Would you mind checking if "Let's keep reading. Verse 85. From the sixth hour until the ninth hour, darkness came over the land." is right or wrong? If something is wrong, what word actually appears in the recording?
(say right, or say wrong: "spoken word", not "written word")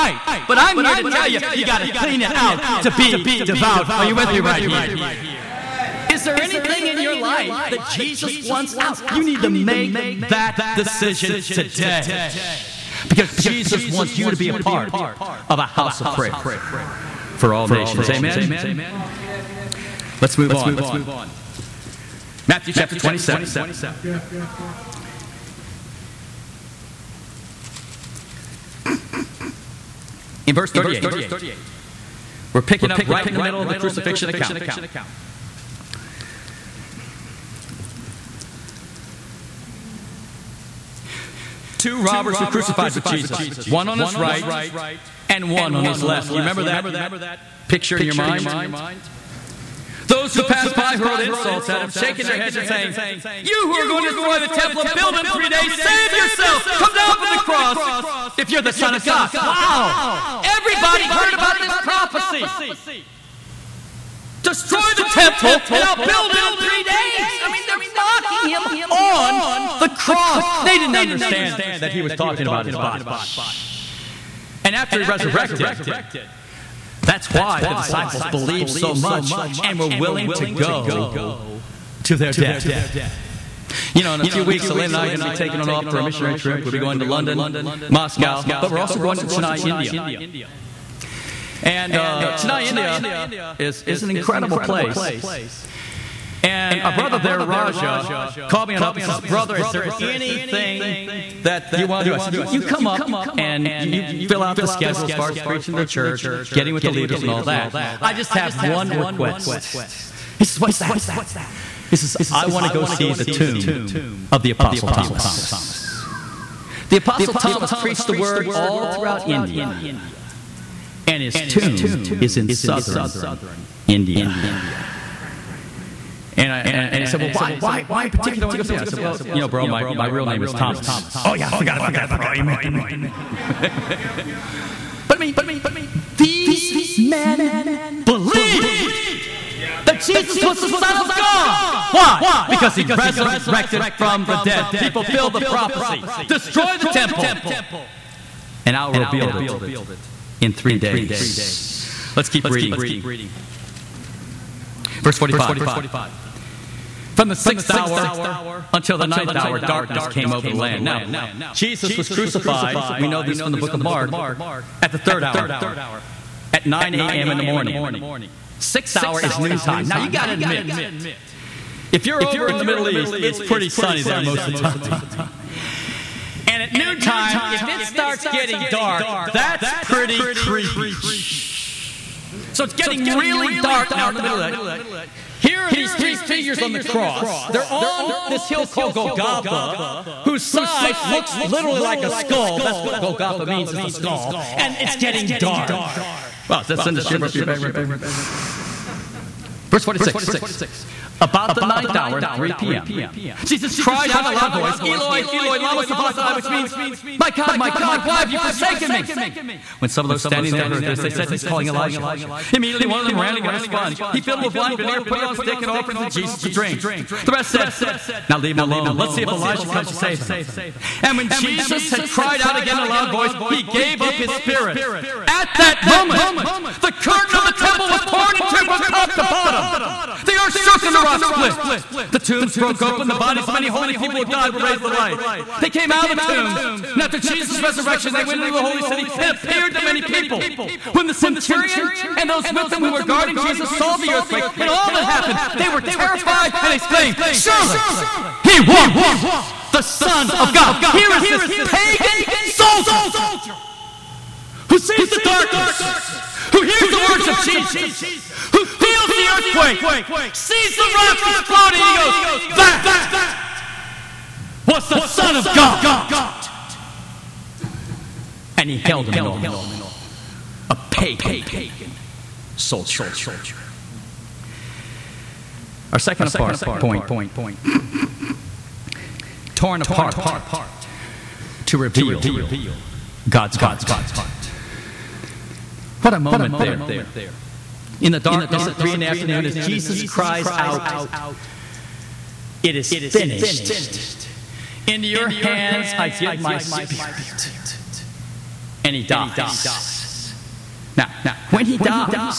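wrong: "45", not "85".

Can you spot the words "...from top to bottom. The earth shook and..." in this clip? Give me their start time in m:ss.
3:48.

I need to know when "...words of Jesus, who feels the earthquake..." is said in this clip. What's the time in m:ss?
4:17.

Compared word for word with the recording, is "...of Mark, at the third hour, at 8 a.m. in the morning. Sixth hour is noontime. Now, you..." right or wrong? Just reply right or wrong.
wrong.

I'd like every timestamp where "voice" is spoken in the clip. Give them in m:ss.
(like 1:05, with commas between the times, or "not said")
3:24, 3:43.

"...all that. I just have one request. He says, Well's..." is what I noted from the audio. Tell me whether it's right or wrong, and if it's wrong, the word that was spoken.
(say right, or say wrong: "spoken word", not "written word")
wrong: "What", not "Well".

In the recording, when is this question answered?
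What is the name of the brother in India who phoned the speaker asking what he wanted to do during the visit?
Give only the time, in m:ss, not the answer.
1:37.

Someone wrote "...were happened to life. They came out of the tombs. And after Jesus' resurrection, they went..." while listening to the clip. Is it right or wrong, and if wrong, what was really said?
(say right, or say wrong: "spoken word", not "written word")
wrong: "raised", not "happened".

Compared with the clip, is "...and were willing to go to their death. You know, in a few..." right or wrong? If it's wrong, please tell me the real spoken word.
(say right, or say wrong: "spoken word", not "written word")
right.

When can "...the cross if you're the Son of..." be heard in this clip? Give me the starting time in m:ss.
0:57.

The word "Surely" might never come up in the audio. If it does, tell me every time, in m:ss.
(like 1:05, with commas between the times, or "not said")
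4:07.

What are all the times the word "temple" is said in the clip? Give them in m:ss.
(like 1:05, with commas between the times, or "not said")
0:54, 1:05, 2:26, 3:47.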